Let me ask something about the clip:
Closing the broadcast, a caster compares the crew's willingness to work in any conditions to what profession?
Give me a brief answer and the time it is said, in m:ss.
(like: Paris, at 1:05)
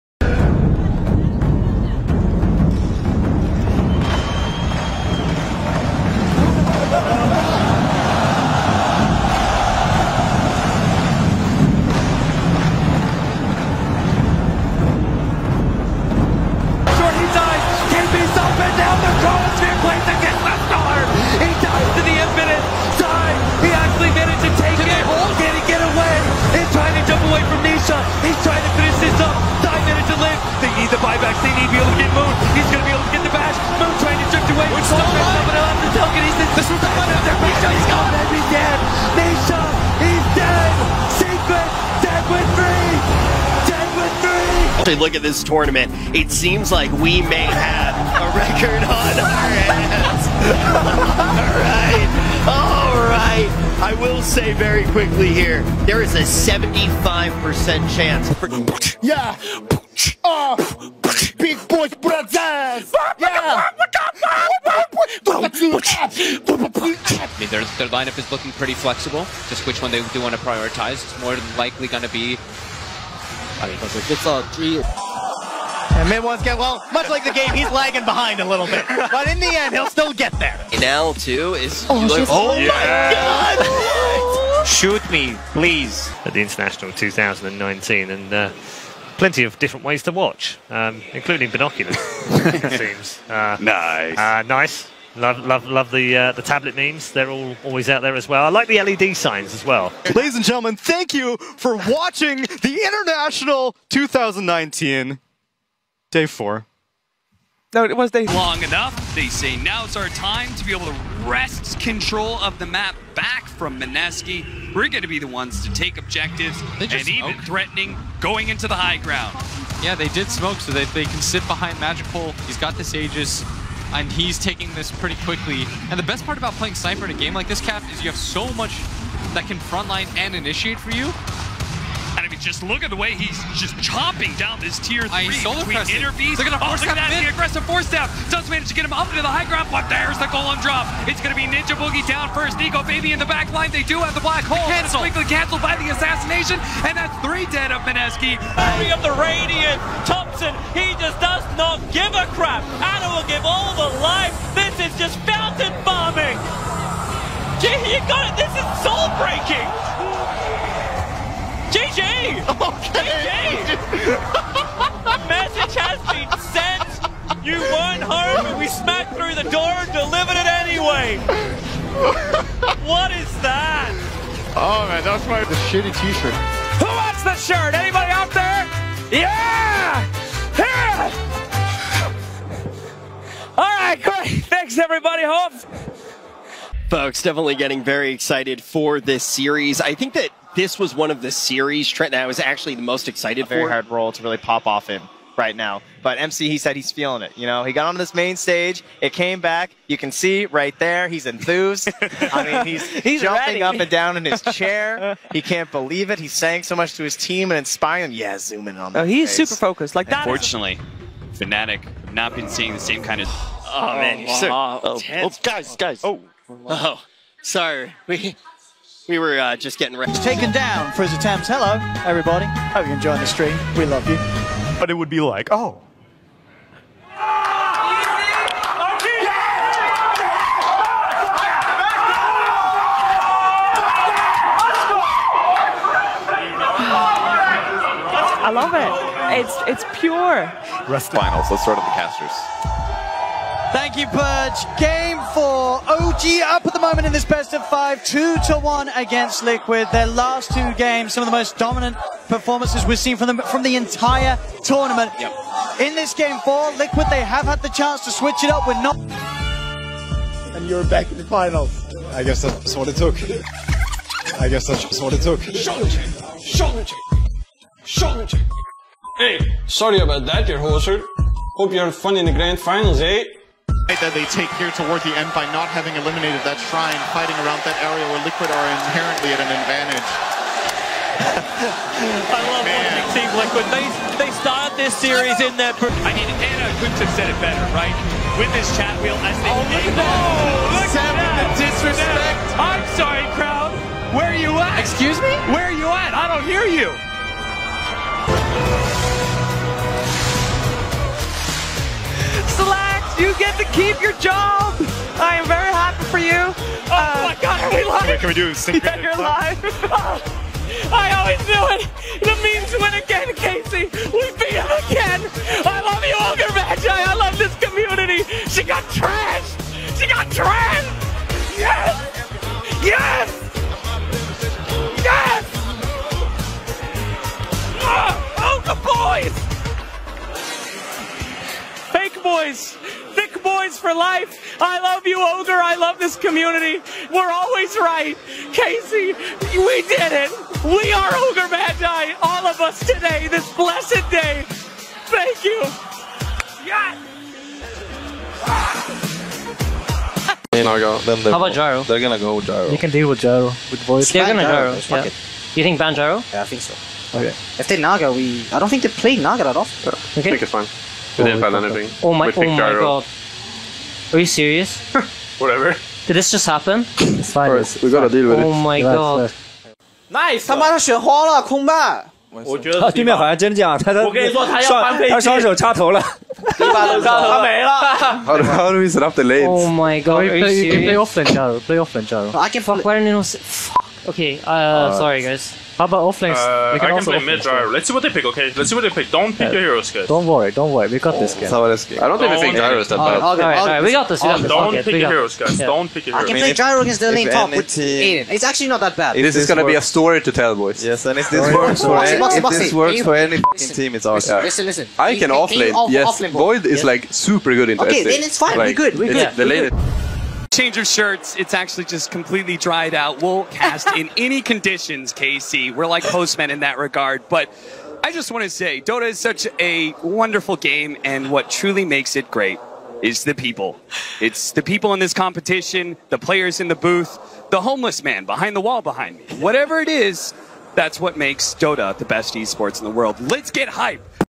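postmen, at 6:56.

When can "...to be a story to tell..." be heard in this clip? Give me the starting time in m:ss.
6:39.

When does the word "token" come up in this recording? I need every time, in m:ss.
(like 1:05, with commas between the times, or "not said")
0:35.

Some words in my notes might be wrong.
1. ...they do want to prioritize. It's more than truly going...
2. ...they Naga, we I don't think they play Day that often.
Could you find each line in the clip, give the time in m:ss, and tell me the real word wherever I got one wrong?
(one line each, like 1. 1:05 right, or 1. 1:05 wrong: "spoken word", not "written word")
1. 1:09 wrong: "likely", not "truly"
2. 5:57 wrong: "Naga", not "Day".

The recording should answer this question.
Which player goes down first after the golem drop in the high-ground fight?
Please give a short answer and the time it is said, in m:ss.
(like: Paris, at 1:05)
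Ninja Boogie, at 2:21.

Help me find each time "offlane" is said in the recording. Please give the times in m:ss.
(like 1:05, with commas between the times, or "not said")
6:26, 6:45.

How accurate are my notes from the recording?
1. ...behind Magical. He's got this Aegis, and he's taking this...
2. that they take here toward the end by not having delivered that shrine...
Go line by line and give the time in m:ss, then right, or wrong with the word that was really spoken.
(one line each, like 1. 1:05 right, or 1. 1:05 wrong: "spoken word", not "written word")
1. 2:01 right
2. 4:33 wrong: "eliminated", not "delivered".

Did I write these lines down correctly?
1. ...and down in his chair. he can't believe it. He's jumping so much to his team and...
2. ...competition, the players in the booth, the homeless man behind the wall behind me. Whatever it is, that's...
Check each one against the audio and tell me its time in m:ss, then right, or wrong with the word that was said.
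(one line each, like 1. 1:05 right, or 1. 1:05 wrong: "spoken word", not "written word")
1. 3:23 wrong: "saying", not "jumping"
2. 7:05 right.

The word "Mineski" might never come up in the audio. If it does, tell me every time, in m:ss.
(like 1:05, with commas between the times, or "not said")
1:53, 2:27.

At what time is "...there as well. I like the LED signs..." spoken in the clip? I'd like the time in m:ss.
1:38.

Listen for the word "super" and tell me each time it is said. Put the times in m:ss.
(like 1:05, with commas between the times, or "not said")
3:29, 6:47.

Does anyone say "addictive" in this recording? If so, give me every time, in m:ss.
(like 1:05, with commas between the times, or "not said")
not said.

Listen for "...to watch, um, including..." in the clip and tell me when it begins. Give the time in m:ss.
1:30.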